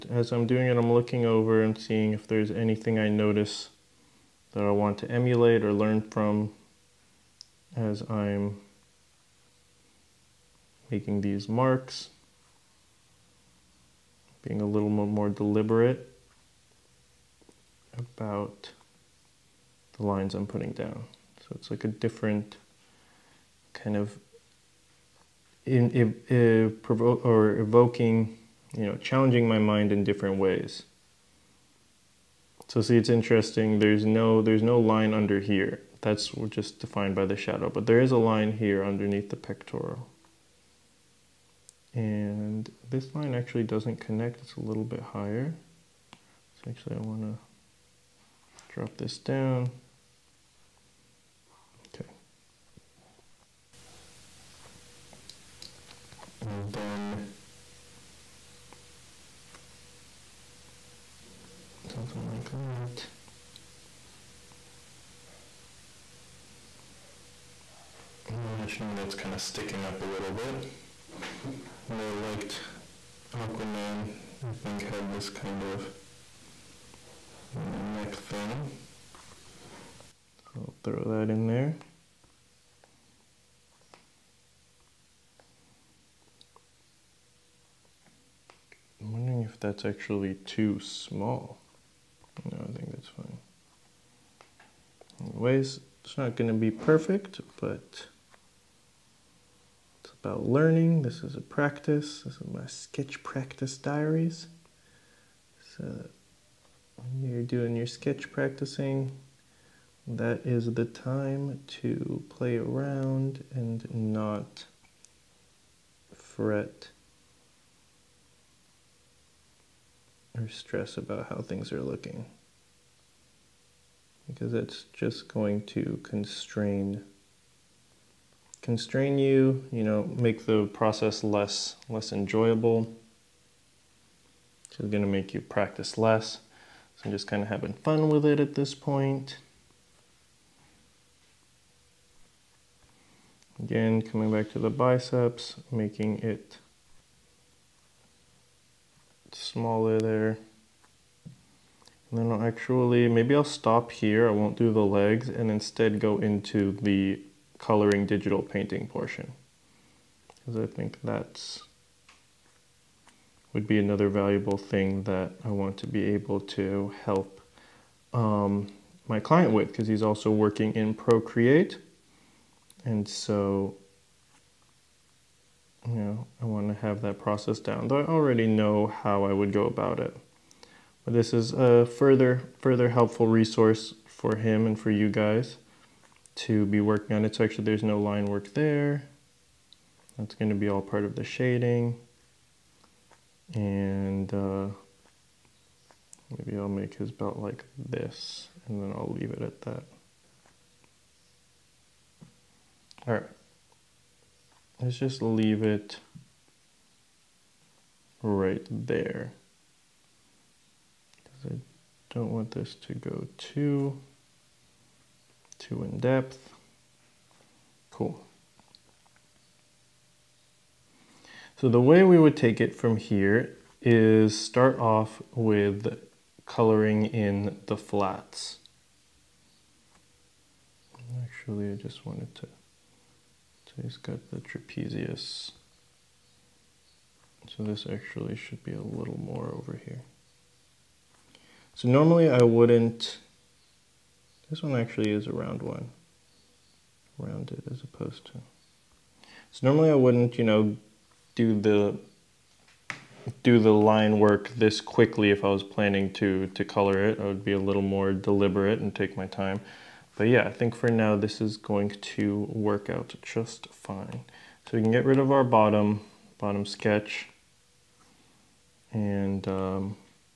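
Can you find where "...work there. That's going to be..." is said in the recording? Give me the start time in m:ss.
3:08.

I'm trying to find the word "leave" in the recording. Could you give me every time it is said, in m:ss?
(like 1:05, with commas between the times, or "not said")
3:19, 3:25.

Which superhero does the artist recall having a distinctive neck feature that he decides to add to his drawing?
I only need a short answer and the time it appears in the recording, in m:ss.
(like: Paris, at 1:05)
Aquaman, at 1:13.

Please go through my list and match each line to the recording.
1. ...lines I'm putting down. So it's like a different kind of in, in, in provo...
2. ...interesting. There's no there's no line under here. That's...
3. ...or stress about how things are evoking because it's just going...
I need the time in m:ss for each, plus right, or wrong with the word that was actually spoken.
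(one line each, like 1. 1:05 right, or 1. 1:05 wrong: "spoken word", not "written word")
1. 0:20 right
2. 0:33 right
3. 2:00 wrong: "looking", not "evoking".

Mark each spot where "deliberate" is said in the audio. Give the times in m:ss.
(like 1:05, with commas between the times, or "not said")
0:15, 4:18.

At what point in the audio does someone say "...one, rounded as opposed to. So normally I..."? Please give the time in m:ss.
4:05.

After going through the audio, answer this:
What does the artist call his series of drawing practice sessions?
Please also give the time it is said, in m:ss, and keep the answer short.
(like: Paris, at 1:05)
sketch practice diaries, at 1:42.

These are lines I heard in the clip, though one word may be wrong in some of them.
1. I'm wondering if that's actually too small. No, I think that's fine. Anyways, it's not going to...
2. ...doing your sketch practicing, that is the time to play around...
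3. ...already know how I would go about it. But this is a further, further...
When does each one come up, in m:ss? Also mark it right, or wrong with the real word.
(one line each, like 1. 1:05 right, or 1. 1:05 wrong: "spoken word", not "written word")
1. 1:28 right
2. 1:47 right
3. 2:58 right.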